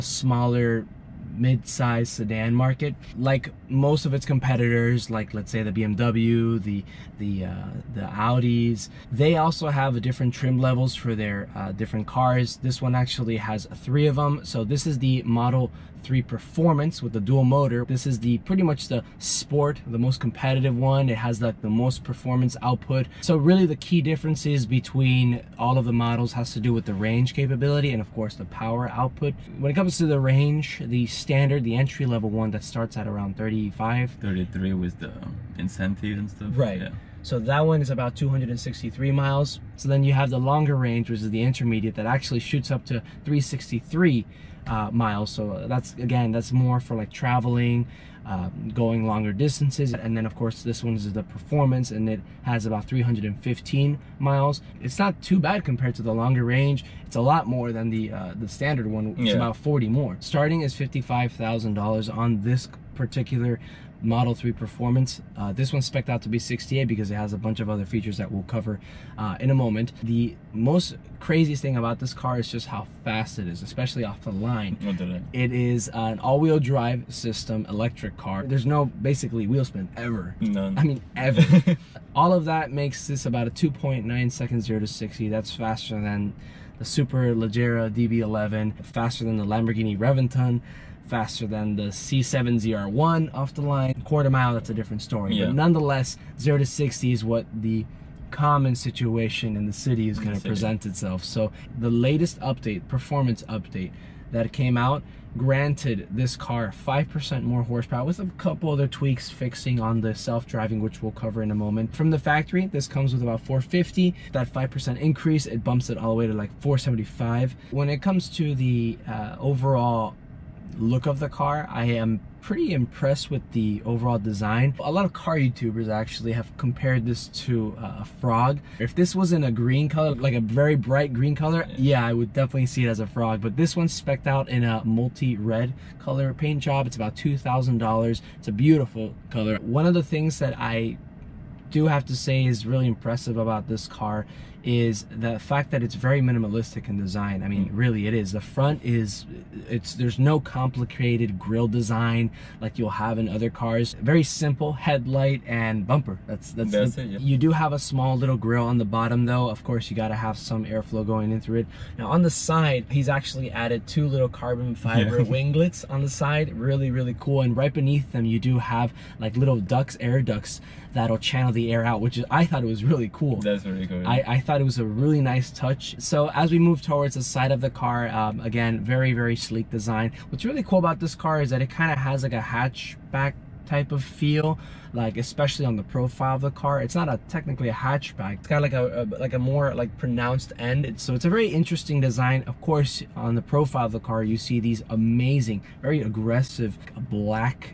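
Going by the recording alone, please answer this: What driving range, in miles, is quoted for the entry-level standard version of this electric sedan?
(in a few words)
263 miles.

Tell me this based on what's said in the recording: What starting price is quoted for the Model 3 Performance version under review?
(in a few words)
$55,000.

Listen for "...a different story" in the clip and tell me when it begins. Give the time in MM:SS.
01:34.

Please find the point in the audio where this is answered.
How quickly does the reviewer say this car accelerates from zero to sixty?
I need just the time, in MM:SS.
01:23.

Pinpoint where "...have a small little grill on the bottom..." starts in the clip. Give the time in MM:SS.
02:37.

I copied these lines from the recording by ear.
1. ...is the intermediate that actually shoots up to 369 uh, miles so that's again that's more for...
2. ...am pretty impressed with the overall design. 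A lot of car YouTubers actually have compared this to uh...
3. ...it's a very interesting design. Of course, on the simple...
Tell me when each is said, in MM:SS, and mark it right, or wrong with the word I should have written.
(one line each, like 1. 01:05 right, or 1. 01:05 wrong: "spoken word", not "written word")
1. 00:41 wrong: "363", not "369"
2. 02:01 right
3. 03:11 wrong: "profile", not "simple".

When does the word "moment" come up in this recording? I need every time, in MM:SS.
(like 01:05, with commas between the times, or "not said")
01:09, 01:51.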